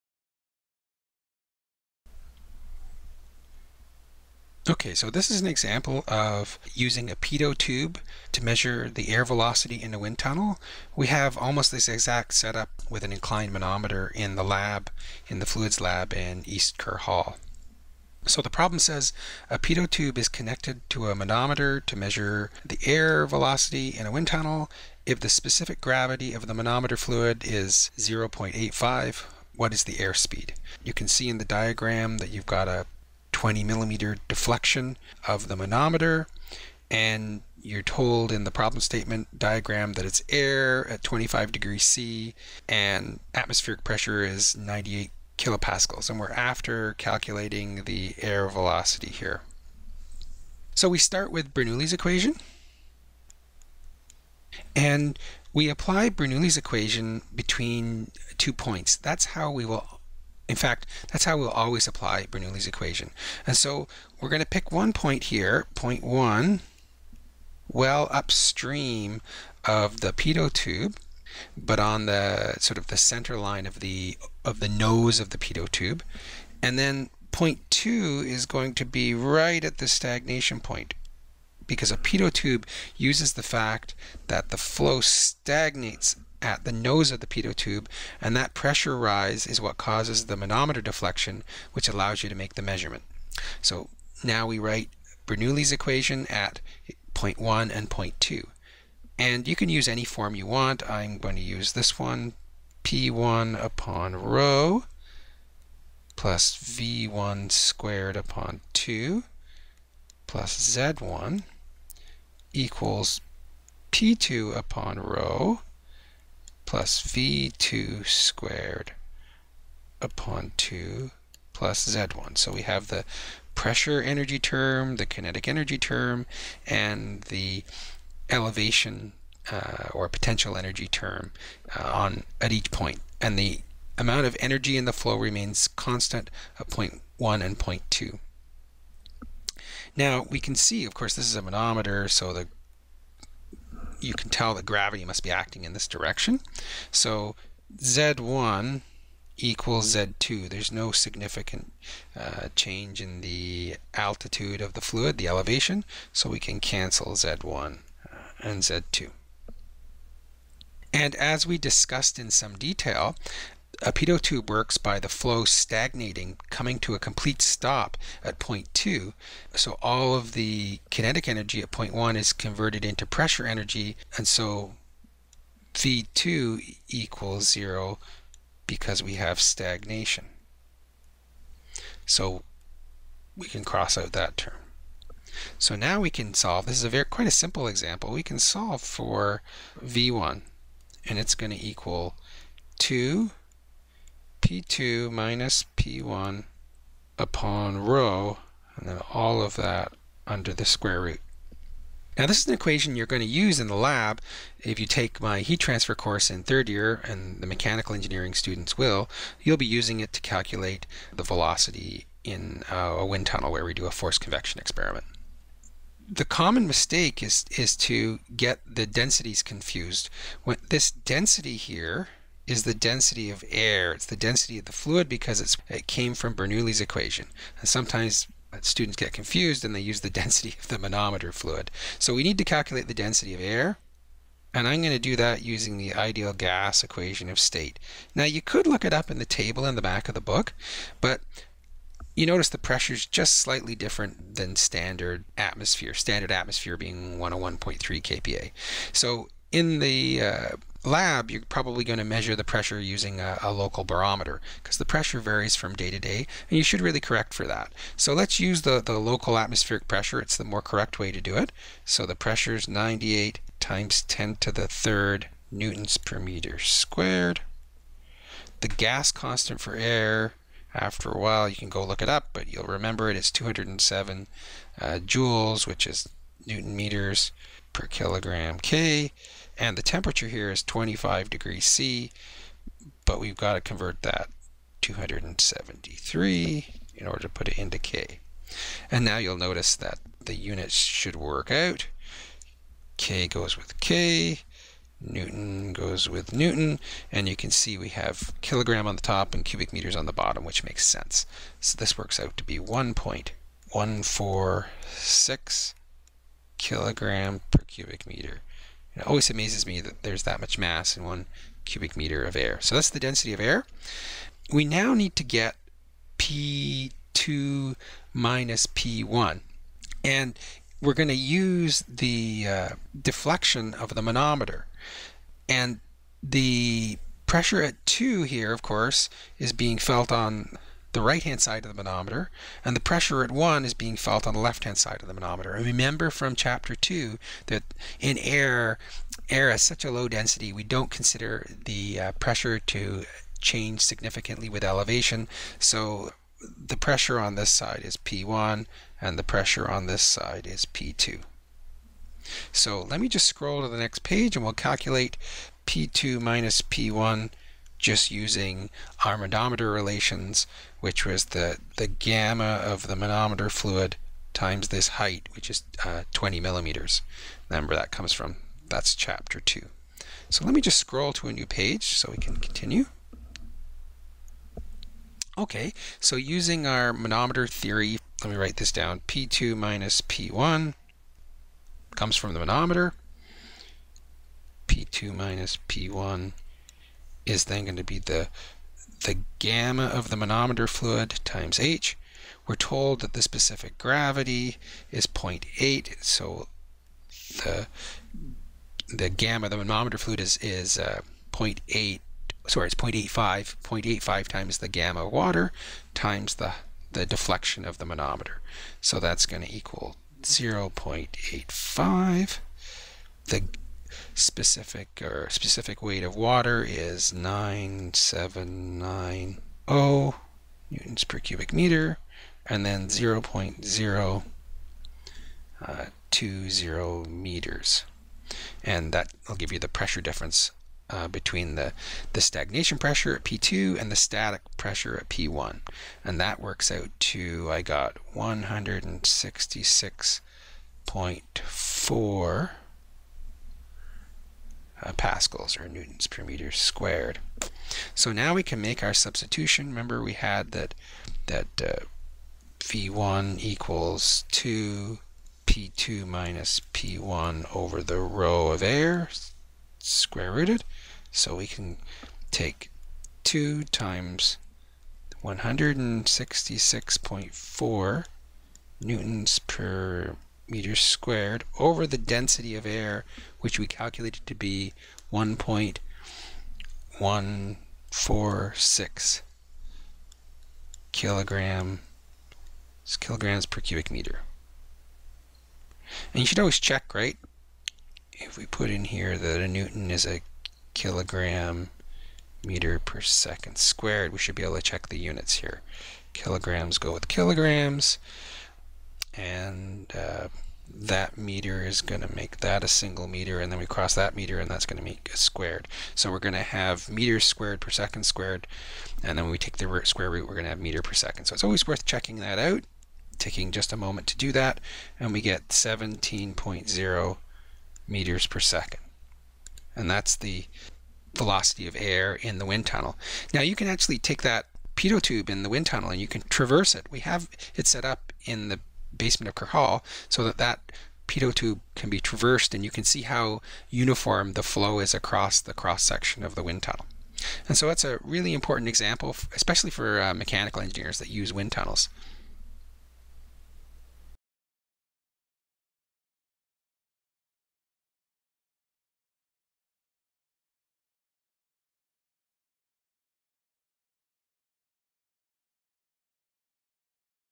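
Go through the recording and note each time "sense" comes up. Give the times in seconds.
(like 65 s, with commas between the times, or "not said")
300 s.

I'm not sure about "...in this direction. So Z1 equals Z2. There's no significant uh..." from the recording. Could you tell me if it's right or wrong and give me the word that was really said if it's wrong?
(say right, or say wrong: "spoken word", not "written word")
right.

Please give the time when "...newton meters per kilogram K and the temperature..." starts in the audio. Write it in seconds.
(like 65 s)
276 s.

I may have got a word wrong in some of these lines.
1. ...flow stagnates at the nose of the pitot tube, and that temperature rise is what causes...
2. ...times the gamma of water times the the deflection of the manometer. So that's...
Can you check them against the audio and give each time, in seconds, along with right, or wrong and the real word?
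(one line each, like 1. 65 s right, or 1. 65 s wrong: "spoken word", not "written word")
1. 84 s wrong: "pressure", not "temperature"
2. 404 s right.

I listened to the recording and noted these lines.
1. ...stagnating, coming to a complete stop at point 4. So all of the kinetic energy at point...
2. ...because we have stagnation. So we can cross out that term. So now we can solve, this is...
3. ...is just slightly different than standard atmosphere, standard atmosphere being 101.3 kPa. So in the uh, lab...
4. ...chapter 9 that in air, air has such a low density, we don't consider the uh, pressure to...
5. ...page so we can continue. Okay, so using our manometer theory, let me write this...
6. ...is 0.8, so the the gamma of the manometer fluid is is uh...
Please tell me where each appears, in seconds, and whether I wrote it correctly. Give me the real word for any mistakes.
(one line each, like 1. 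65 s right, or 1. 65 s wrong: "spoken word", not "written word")
1. 165 s wrong: "2", not "4"
2. 178 s right
3. 242 s right
4. 336 s wrong: "2", not "9"
5. 371 s right
6. 394 s right.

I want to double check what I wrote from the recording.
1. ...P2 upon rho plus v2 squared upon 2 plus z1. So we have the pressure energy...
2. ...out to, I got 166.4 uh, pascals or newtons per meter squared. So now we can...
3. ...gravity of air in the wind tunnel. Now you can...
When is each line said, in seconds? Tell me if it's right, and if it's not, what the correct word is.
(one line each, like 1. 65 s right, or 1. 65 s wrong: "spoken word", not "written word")
1. 113 s right
2. 436 s right
3. 521 s wrong: "velocity", not "gravity".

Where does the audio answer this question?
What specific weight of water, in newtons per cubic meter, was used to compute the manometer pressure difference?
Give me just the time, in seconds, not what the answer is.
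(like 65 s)
417 s.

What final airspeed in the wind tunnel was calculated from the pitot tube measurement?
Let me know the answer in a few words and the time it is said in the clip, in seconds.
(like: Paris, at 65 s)
17.0 meters per second, at 515 s.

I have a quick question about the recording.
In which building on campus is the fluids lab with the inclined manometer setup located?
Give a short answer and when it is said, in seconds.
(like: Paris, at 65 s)
East Kerr Hall, at 16 s.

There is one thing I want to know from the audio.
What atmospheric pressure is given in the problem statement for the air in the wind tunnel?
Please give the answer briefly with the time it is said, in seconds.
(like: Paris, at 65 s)
98 kilopascals, at 44 s.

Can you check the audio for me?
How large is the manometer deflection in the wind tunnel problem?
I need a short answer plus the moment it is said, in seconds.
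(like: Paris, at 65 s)
20 millimeters, at 33 s.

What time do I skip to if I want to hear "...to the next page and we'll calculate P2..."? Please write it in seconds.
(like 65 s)
353 s.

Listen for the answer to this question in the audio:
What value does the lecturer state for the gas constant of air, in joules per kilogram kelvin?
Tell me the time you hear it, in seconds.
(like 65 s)
273 s.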